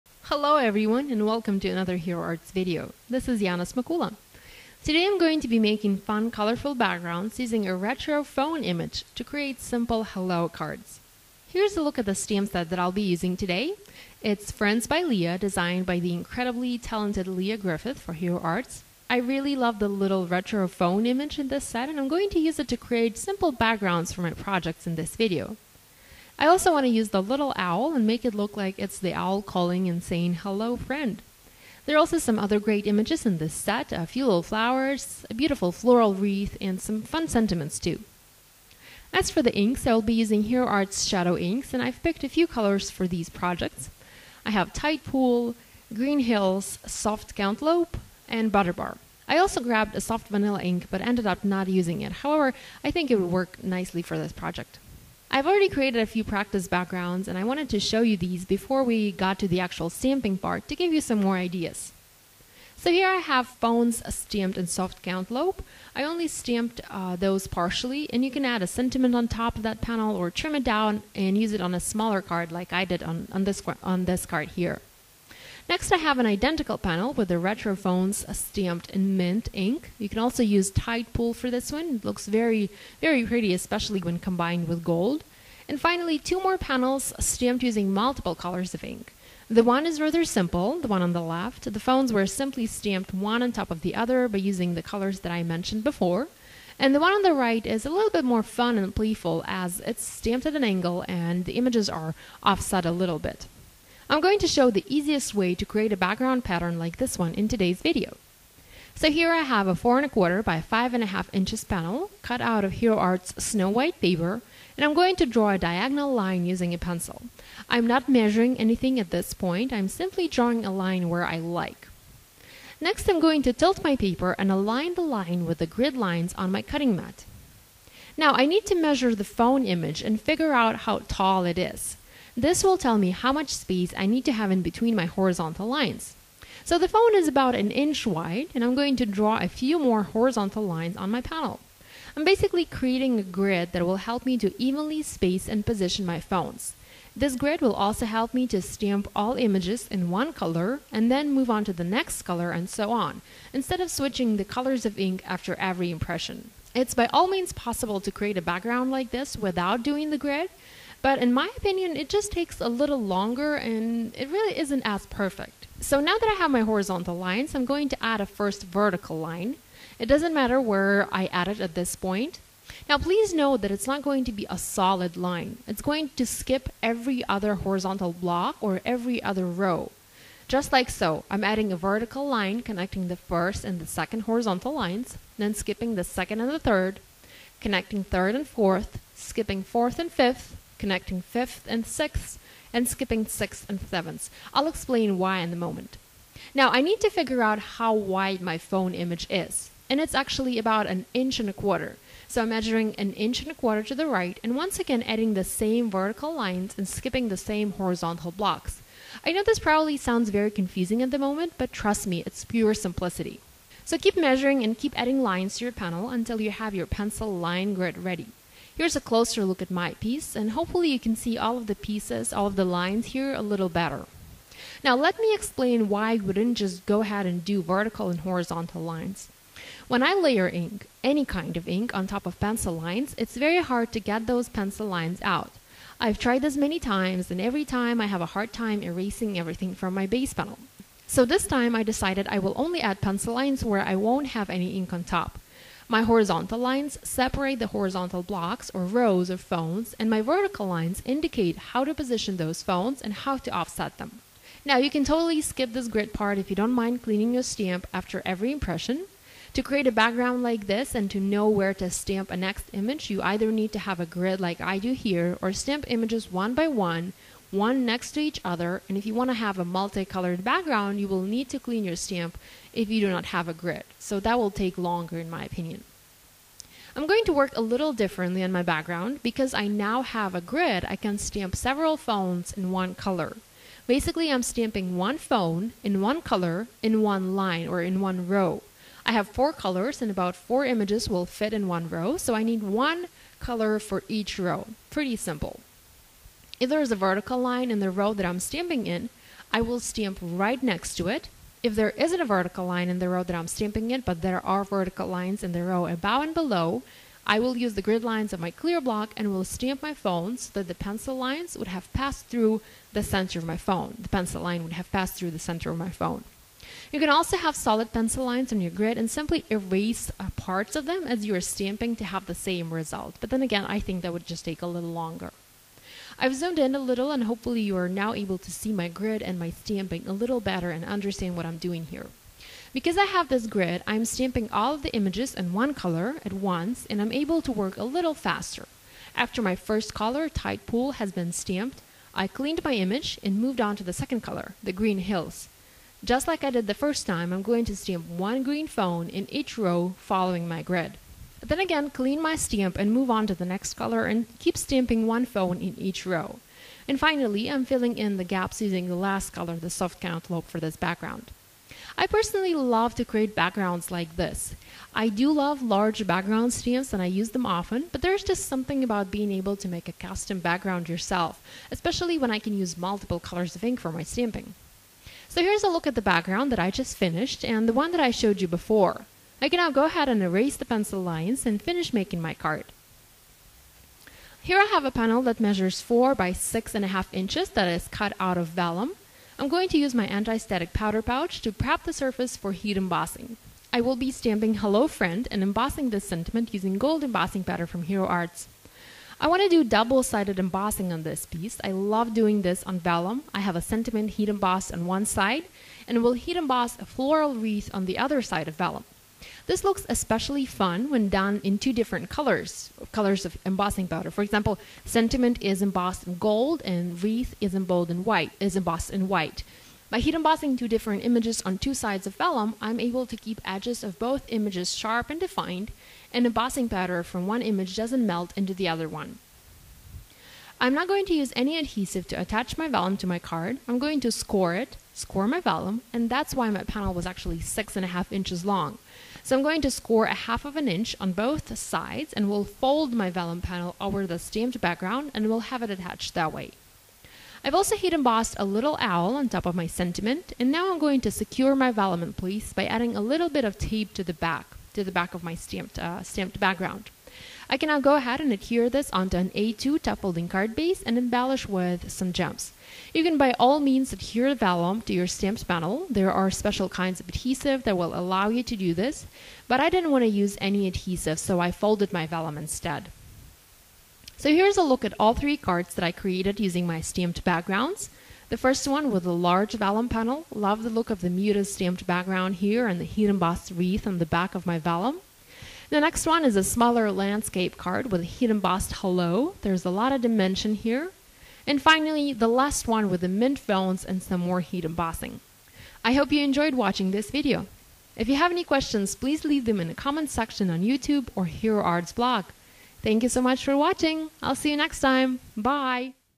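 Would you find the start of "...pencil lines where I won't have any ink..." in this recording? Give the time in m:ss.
4:02.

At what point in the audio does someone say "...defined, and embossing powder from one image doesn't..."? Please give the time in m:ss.
7:05.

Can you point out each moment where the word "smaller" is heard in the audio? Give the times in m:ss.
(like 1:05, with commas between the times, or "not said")
1:11, 8:06.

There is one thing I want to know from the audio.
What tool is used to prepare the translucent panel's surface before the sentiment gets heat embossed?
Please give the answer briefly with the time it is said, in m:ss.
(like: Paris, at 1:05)
anti-static powder pouch, at 6:30.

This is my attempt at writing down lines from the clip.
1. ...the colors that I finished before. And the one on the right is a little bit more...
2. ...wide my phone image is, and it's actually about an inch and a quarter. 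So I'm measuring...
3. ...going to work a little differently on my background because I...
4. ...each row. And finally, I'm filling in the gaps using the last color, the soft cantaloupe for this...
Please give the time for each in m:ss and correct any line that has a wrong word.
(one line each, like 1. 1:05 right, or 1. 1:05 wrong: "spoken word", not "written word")
1. 1:34 wrong: "mentioned", not "finished"
2. 3:17 right
3. 4:37 right
4. 5:55 right.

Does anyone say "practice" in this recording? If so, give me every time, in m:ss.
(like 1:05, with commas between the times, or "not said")
0:56.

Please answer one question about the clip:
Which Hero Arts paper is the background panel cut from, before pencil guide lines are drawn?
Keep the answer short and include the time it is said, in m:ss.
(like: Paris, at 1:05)
Snow White, at 1:53.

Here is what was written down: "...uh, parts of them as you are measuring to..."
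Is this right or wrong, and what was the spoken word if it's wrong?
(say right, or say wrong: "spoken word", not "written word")
wrong: "stamping", not "measuring".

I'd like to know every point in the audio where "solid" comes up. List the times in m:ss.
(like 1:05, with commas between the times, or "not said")
2:54, 5:17.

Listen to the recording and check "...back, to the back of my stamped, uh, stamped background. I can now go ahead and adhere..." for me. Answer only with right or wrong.
right.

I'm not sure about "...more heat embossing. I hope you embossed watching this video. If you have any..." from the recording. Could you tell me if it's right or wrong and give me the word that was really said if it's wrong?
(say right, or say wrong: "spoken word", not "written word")
wrong: "enjoyed", not "embossed".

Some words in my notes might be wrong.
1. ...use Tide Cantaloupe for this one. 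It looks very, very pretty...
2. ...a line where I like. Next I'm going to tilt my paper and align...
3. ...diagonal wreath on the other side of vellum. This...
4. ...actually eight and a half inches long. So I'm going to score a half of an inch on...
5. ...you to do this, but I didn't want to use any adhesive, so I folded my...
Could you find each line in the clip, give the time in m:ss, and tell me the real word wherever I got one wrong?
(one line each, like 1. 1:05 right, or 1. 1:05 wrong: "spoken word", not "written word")
1. 1:20 wrong: "Pool", not "Cantaloupe"
2. 2:00 right
3. 6:46 wrong: "floral", not "diagonal"
4. 7:17 wrong: "six", not "eight"
5. 7:48 right.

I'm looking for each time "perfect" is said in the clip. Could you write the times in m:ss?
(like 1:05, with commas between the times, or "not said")
2:45.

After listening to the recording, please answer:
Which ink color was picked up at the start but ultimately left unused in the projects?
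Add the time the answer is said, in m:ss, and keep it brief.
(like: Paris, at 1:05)
Soft Vanilla, at 0:50.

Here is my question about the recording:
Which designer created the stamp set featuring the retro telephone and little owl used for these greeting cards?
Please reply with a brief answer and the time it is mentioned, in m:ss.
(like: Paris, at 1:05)
Lia Griffith, at 0:17.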